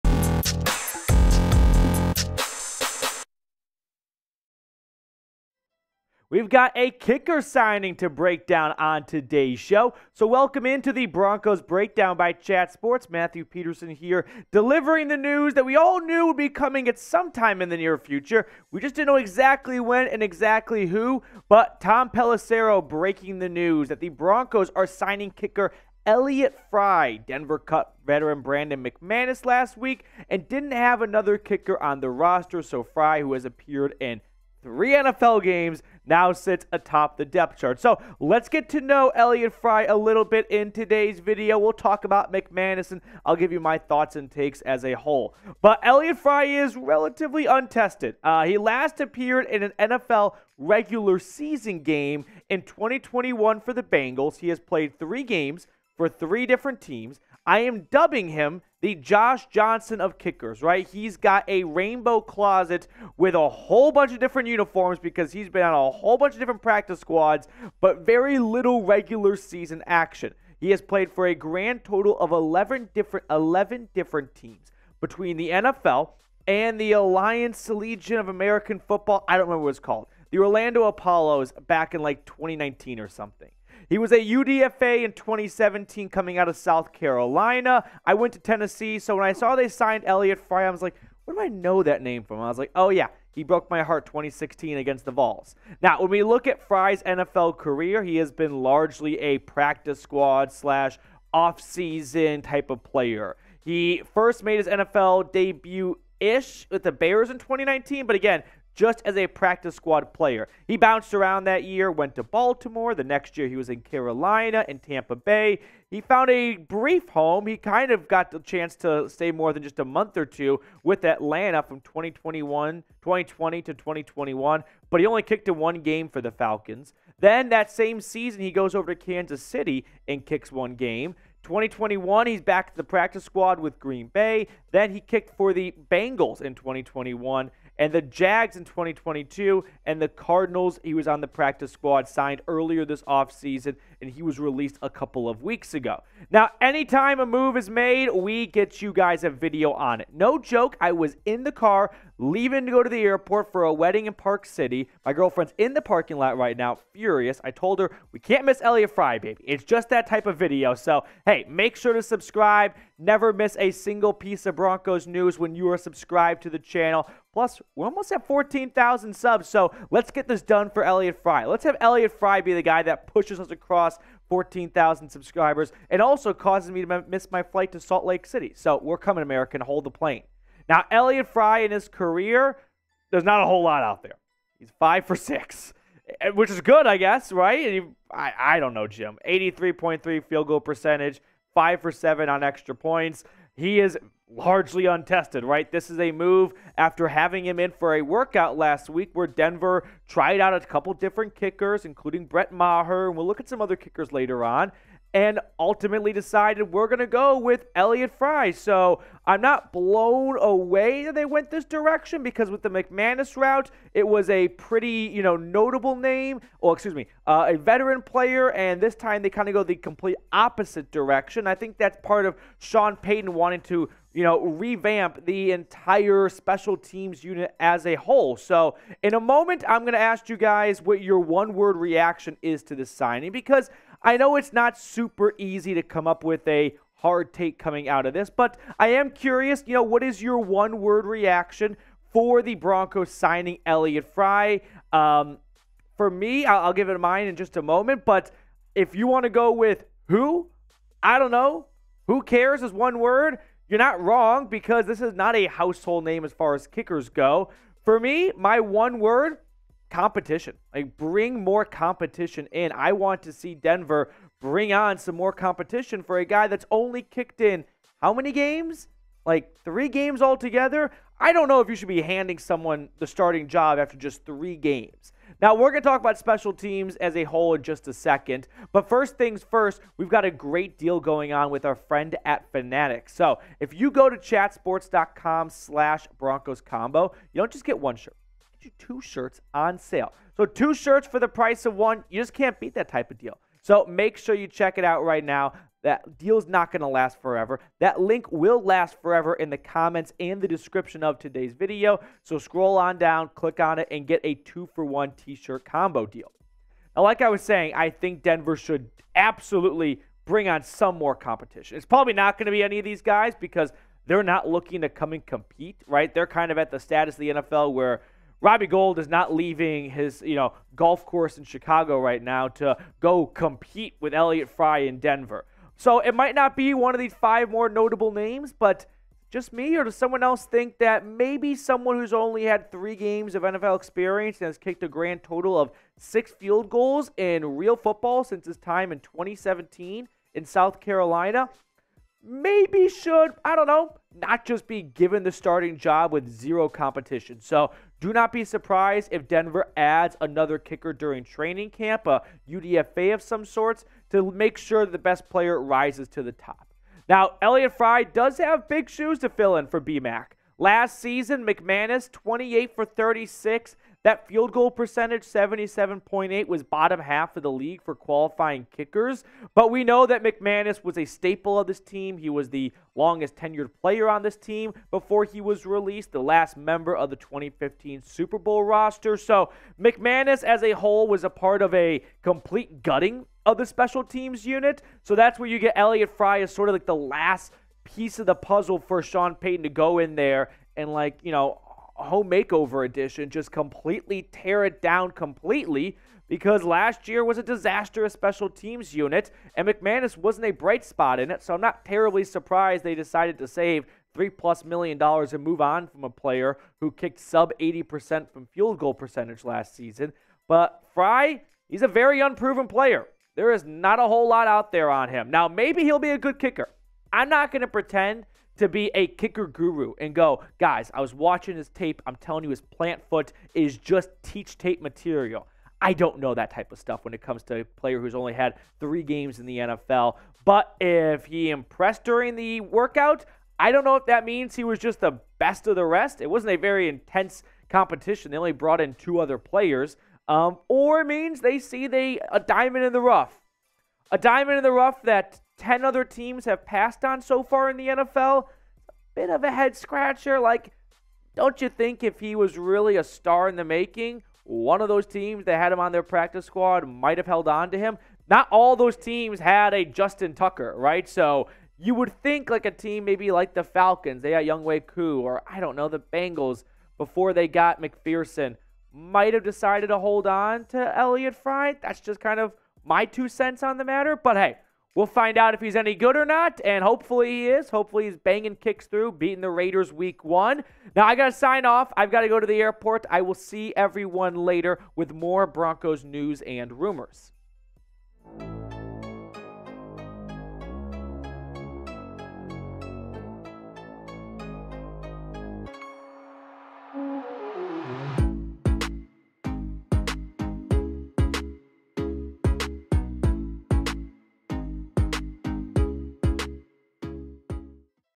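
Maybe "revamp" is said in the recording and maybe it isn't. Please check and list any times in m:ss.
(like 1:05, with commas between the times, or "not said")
3:44.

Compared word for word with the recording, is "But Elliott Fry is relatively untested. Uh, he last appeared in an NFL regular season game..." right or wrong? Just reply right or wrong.
right.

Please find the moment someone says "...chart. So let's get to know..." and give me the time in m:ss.
0:37.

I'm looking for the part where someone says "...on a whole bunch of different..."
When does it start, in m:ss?
1:05.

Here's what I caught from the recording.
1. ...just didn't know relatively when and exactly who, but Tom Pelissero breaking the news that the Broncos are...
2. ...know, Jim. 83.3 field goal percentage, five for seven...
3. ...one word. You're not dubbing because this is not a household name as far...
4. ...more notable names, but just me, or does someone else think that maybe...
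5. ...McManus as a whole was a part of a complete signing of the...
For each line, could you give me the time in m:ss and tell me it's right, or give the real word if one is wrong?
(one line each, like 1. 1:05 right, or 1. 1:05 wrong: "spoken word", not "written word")
1. 0:18 wrong: "exactly", not "relatively"
2. 3:08 right
3. 4:12 wrong: "wrong", not "dubbing"
4. 5:27 right
5. 6:19 wrong: "gutting", not "signing".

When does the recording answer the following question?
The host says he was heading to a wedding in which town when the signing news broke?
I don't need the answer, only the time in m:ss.
2:34.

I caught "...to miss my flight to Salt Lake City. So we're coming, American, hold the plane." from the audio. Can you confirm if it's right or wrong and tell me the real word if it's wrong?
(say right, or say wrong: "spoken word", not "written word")
right.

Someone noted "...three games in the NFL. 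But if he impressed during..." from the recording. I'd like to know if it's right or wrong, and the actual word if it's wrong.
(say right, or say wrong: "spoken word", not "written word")
right.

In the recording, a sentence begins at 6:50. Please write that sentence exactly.
But Fry, he's a very unproven player.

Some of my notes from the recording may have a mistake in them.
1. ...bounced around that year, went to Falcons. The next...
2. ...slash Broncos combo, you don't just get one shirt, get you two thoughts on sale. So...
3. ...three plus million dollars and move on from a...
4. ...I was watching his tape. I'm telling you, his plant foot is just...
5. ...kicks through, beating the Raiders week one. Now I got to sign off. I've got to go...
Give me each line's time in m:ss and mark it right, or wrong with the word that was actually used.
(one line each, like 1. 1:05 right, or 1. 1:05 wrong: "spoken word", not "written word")
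1. 1:50 wrong: "Baltimore", not "Falcons"
2. 4:45 wrong: "shirts", not "thoughts"
3. 6:44 right
4. 7:00 right
5. 7:58 right.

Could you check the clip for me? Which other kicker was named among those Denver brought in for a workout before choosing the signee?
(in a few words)
Brett Maher.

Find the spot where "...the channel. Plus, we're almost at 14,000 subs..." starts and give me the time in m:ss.
2:46.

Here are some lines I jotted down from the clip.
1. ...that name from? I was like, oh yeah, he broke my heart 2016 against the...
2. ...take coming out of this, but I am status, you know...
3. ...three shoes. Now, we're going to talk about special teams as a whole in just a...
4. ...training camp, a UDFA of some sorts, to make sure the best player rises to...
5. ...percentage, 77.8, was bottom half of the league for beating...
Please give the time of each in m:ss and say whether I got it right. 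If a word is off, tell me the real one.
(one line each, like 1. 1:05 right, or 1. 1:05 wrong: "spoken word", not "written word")
1. 1:31 right
2. 3:57 wrong: "curious", not "status"
3. 4:34 wrong: "games", not "shoes"
4. 5:51 right
5. 6:04 wrong: "qualifying", not "beating".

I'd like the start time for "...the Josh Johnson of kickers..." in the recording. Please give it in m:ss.
0:58.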